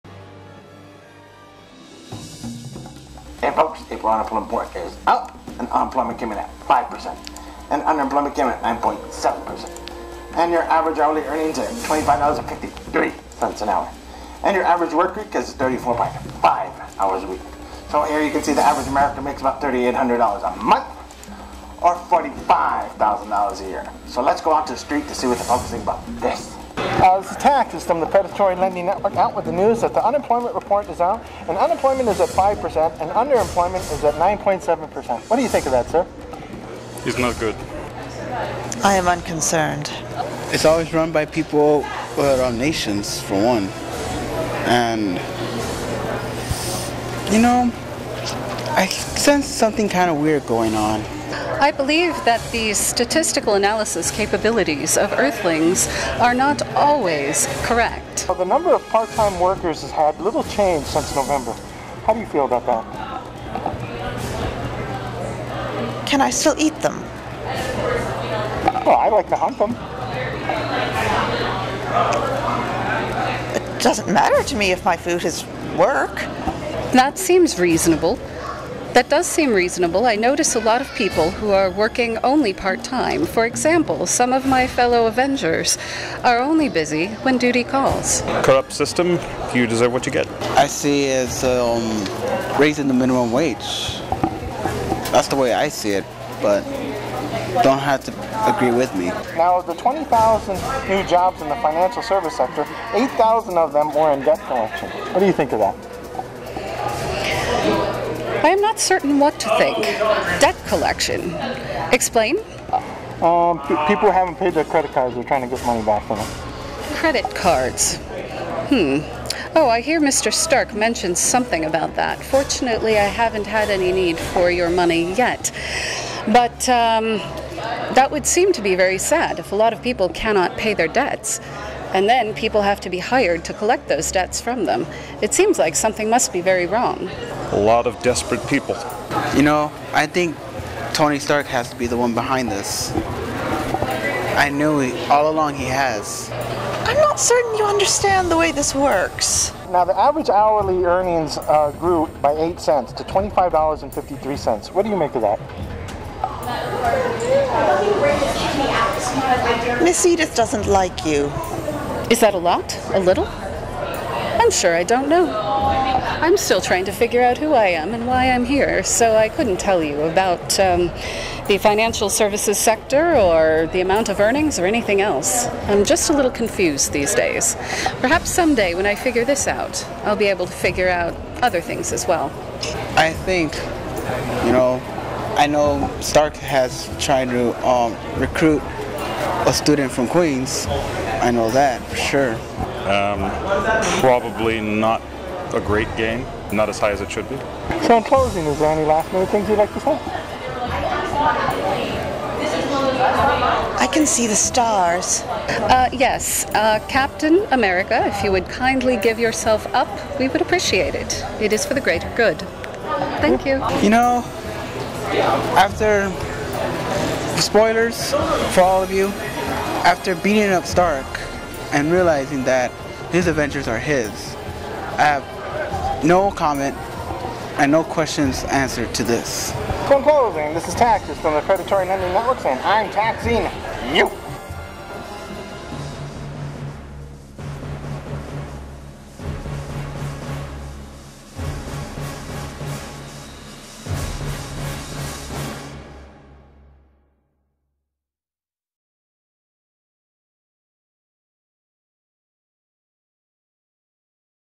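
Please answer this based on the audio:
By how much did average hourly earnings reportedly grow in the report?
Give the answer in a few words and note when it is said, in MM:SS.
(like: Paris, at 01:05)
8 cents, at 02:32.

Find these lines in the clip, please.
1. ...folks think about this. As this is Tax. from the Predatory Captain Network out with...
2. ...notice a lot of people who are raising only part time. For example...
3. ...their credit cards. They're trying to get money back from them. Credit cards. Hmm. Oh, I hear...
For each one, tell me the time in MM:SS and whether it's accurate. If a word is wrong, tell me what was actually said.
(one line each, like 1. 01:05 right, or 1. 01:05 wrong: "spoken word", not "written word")
1. 00:25 wrong: "Lending", not "Captain"
2. 01:20 wrong: "working", not "raising"
3. 01:54 right.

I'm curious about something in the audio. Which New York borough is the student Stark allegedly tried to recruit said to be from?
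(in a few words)
Queens.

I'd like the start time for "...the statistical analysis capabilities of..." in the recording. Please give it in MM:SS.
00:52.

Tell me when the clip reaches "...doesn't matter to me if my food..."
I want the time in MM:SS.
01:13.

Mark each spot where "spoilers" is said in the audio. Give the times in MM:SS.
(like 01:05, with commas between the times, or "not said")
03:37.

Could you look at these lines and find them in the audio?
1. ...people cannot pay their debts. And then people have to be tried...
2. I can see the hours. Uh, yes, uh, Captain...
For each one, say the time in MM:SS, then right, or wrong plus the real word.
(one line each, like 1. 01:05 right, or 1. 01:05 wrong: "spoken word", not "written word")
1. 02:09 wrong: "hired", not "tried"
2. 03:23 wrong: "stars", not "hours".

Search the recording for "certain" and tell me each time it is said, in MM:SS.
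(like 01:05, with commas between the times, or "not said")
01:48, 02:27.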